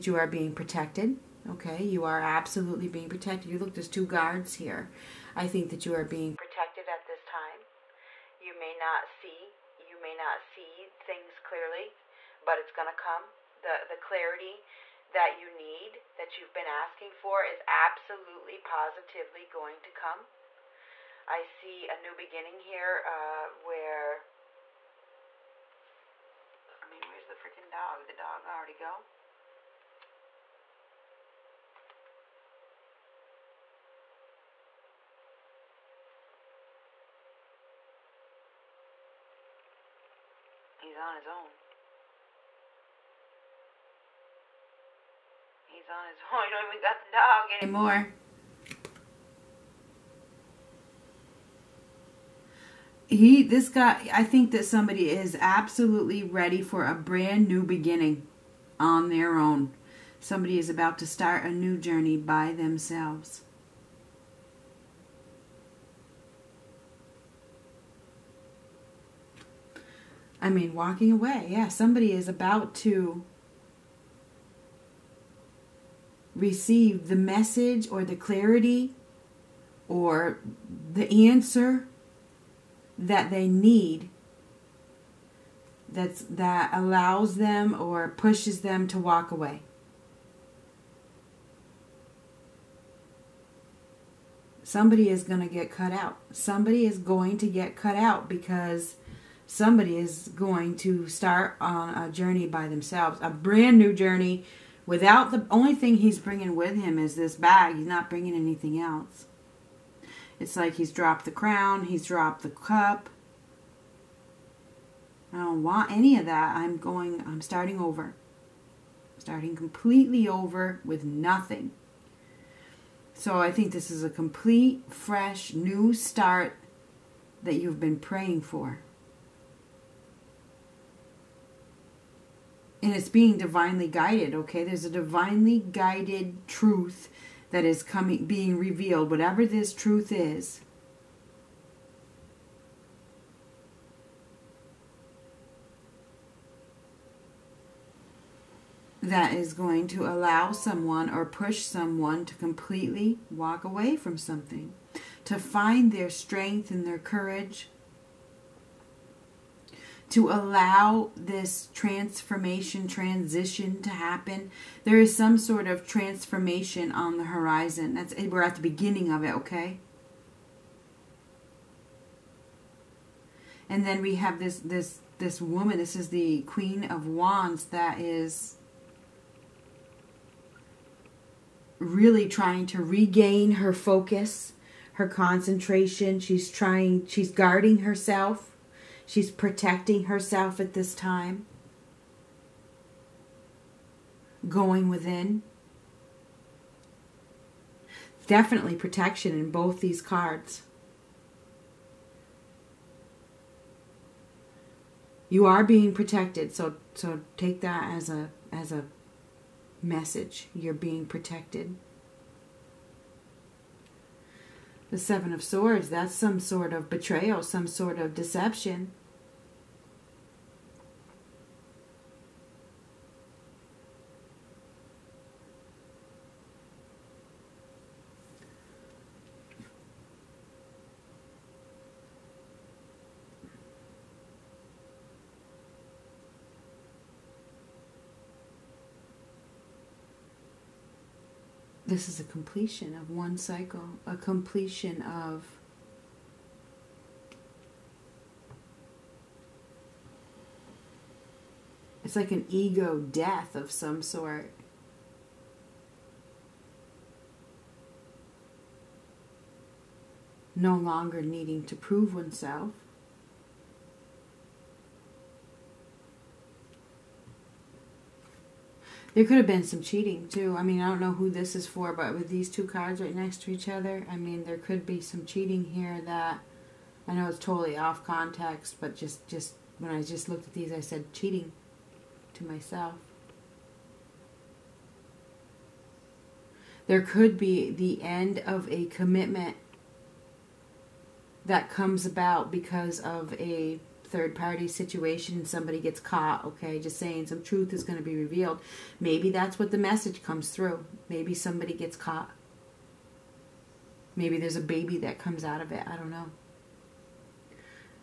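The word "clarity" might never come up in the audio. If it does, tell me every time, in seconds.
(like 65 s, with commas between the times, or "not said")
13 s, 78 s.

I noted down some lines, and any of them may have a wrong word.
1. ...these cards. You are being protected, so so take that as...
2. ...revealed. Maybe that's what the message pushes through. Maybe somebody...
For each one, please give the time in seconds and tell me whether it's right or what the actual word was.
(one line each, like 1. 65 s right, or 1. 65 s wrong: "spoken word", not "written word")
1. 199 s right
2. 298 s wrong: "comes", not "pushes".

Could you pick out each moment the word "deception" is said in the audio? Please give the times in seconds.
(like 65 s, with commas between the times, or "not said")
218 s.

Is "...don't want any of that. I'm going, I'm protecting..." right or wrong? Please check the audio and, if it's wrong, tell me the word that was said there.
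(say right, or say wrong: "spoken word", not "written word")
wrong: "starting", not "protecting".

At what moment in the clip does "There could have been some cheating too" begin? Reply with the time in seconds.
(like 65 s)
269 s.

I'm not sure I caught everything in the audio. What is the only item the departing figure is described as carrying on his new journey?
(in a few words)
bag.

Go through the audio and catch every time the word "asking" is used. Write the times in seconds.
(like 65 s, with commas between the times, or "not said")
16 s.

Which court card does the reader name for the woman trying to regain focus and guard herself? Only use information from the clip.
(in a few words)
Queen of Wands.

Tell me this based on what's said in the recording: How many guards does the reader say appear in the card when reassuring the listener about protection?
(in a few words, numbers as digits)
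2.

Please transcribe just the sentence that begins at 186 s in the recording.
She's trying, she's guarding herself She's protecting herself at this time.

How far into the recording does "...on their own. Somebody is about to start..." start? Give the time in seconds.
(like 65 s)
58 s.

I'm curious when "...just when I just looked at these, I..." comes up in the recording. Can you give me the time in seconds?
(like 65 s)
279 s.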